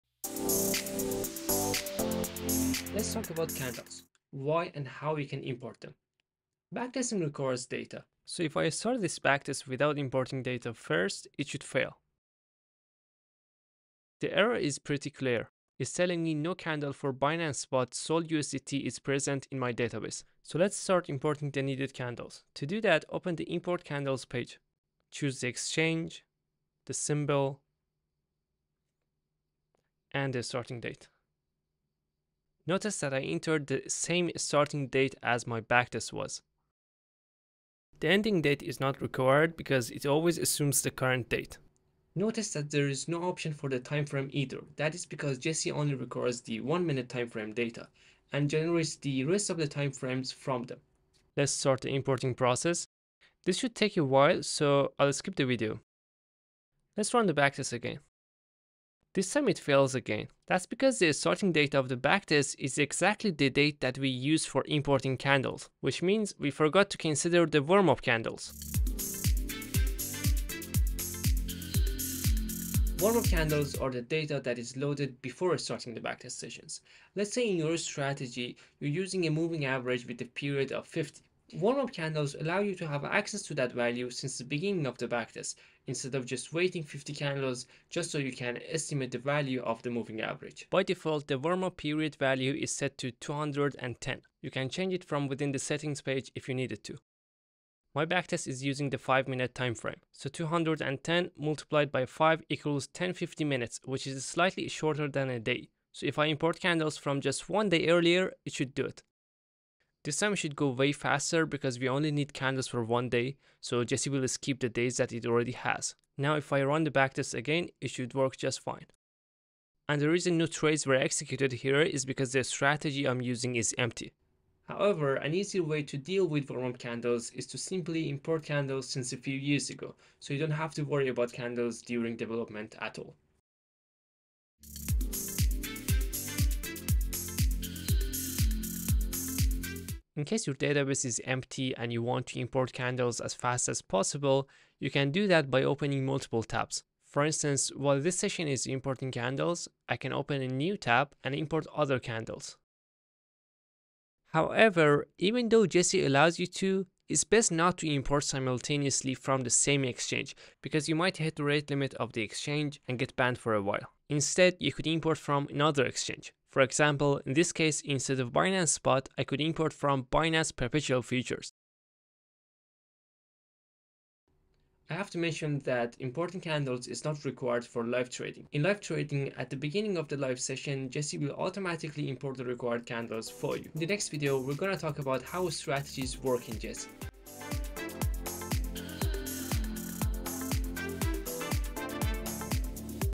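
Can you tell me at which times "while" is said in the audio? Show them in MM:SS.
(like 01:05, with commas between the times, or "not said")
00:54, 02:27, 02:43.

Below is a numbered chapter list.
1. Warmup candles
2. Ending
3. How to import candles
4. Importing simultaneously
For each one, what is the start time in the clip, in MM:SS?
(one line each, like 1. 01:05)
1. 01:07
2. 02:54
3. 00:20
4. 02:15.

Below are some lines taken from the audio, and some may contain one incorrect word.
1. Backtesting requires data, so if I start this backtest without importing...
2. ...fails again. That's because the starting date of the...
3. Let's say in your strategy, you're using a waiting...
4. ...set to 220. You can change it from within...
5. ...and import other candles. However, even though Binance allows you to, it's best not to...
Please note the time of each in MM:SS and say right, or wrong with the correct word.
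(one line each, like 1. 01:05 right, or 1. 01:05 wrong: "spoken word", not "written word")
1. 00:06 right
2. 00:59 right
3. 01:17 wrong: "moving", not "waiting"
4. 01:32 wrong: "210", not "220"
5. 02:31 wrong: "Jesse", not "Binance".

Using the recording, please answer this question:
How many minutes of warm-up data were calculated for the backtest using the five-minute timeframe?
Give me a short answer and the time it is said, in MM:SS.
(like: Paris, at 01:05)
1050, at 01:42.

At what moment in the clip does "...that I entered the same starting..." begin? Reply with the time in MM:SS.
00:32.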